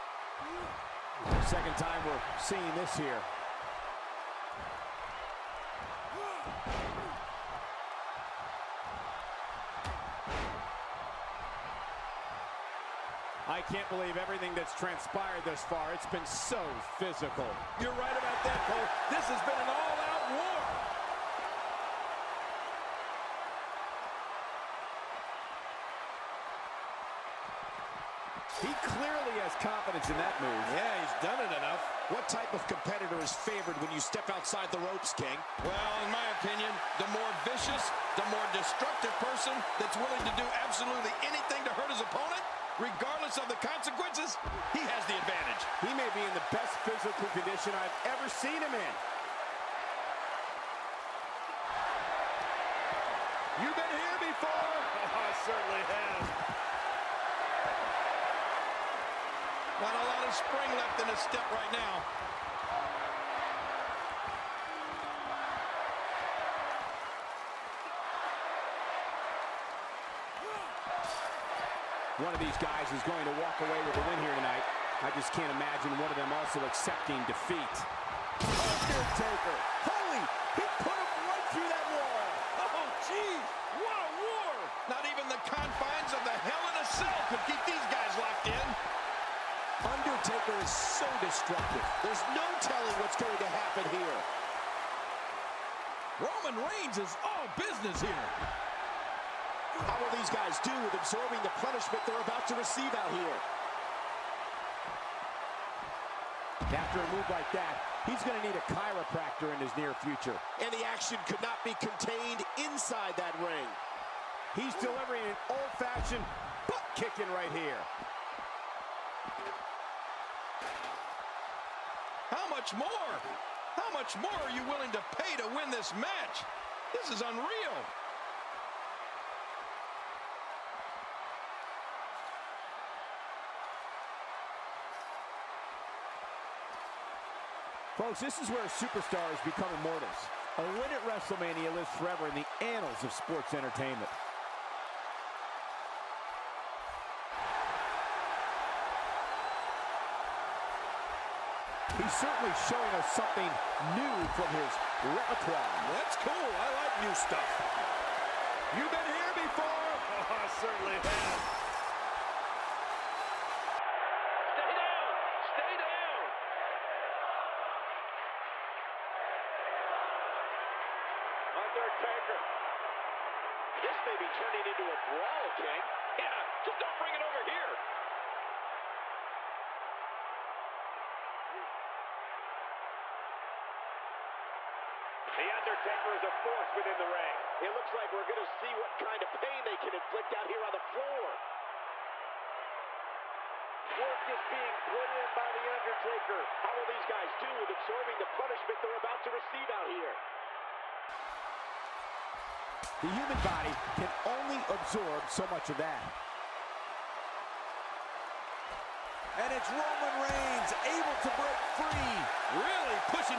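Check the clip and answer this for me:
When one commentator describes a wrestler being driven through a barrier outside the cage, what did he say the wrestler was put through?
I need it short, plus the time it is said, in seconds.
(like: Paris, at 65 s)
wall, at 81 s.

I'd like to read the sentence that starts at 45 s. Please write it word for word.
He may be in the best physical condition I've ever seen him in.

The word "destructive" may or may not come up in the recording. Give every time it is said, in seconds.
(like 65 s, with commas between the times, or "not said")
38 s, 91 s.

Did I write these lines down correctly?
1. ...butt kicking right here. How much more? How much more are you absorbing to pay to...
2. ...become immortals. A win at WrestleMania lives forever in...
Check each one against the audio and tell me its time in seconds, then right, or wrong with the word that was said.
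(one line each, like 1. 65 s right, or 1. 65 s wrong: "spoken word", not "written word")
1. 116 s wrong: "willing", not "absorbing"
2. 139 s right.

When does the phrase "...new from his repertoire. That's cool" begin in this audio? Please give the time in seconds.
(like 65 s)
153 s.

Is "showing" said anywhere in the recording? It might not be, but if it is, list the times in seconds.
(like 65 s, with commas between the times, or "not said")
152 s.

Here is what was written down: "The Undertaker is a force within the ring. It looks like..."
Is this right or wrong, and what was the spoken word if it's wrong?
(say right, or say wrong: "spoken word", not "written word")
right.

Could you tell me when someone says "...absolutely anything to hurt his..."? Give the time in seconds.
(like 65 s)
40 s.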